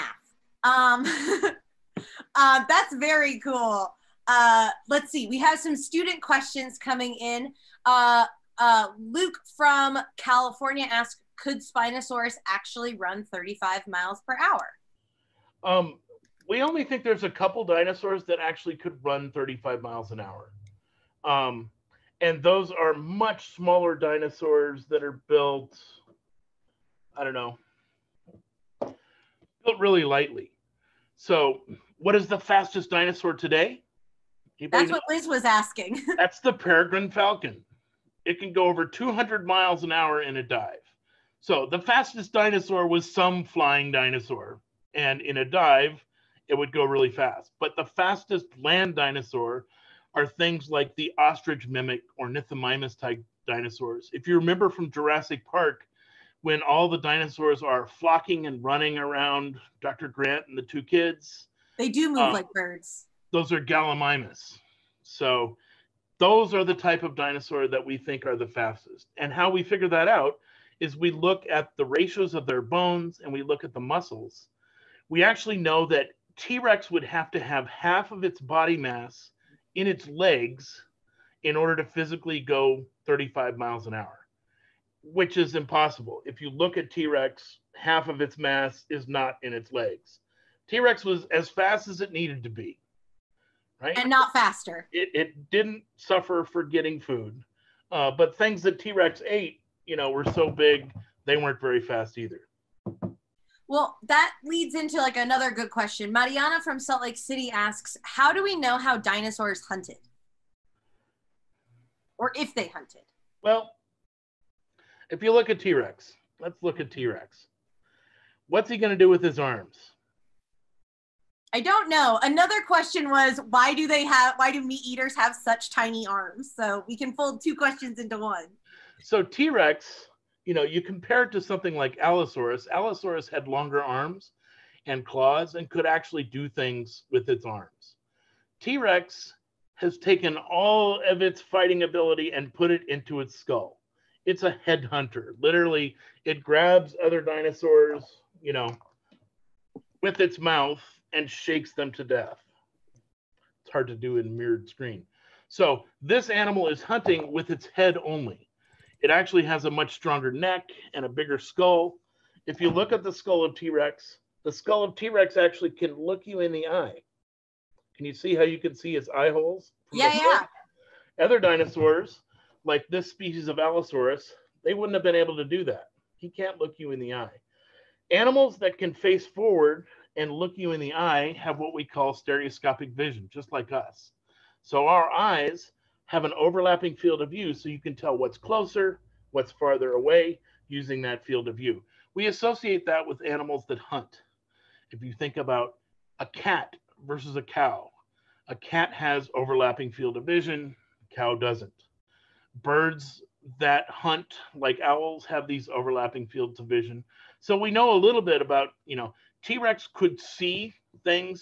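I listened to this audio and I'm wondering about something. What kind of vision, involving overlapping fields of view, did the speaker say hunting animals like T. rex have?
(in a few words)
stereoscopic vision.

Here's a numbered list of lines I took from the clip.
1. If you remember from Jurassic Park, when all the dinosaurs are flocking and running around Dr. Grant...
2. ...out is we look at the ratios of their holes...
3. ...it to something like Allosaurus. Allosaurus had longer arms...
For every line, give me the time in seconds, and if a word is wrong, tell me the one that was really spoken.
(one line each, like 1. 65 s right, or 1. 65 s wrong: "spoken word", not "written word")
1. 54 s right
2. 70 s wrong: "bones", not "holes"
3. 131 s right.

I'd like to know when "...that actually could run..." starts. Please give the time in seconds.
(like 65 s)
18 s.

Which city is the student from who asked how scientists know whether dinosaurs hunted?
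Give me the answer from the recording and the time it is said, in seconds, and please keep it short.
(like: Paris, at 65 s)
Salt Lake City, at 106 s.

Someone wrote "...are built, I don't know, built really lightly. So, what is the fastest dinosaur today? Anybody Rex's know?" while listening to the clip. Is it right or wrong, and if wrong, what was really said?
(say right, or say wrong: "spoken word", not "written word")
wrong: "That", not "Rex".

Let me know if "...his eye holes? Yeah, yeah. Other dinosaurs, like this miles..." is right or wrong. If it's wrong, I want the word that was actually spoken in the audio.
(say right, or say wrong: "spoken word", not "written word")
wrong: "species", not "miles".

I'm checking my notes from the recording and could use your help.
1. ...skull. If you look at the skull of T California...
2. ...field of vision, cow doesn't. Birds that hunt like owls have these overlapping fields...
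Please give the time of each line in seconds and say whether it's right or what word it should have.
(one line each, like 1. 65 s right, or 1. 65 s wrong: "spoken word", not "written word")
1. 161 s wrong: "Rex", not "California"
2. 199 s right.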